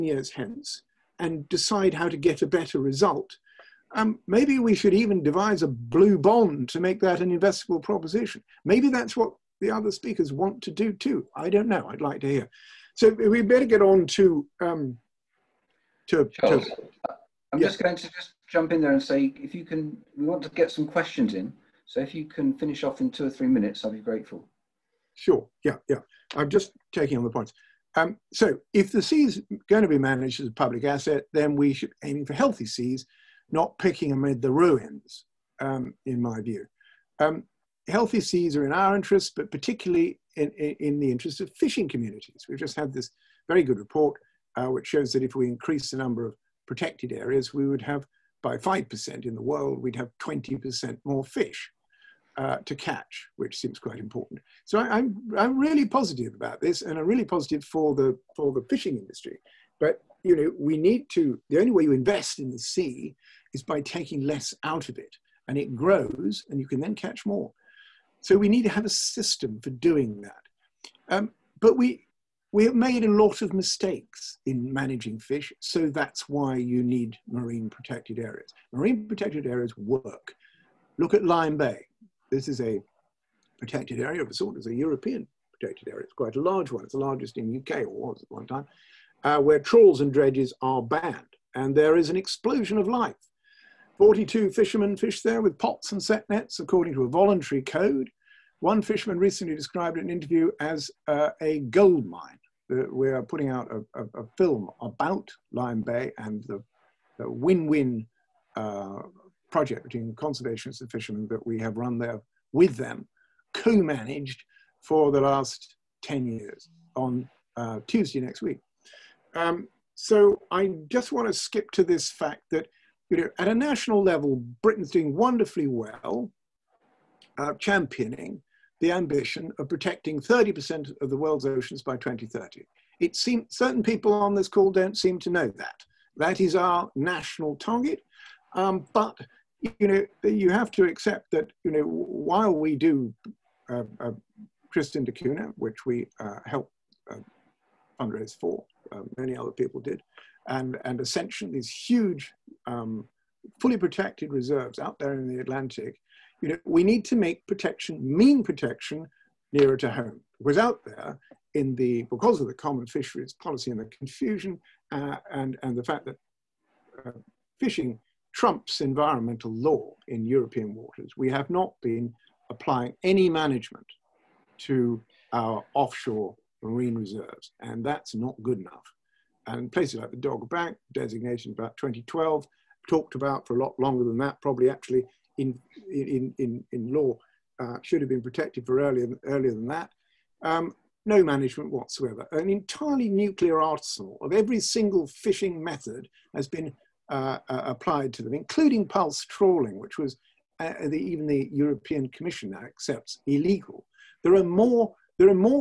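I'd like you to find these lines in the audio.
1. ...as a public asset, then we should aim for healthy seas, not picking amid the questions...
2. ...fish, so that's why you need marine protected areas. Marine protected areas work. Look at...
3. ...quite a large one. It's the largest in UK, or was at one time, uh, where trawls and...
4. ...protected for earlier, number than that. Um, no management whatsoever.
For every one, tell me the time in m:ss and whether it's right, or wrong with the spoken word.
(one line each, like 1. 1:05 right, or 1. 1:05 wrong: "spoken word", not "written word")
1. 0:30 wrong: "ruins", not "questions"
2. 1:15 right
3. 1:26 right
4. 3:08 wrong: "earlier", not "number".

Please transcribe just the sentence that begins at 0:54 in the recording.
So I, am I'm, I'm really positive about this, and I'm really positive for the for the fishing industry.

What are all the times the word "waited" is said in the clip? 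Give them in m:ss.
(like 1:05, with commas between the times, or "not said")
not said.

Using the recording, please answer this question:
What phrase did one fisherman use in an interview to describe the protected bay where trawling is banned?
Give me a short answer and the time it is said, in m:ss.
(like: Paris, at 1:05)
a gold mine, at 1:41.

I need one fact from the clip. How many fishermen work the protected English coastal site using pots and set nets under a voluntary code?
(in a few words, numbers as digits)
42.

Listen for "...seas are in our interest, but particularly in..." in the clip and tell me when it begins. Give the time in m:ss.
0:38.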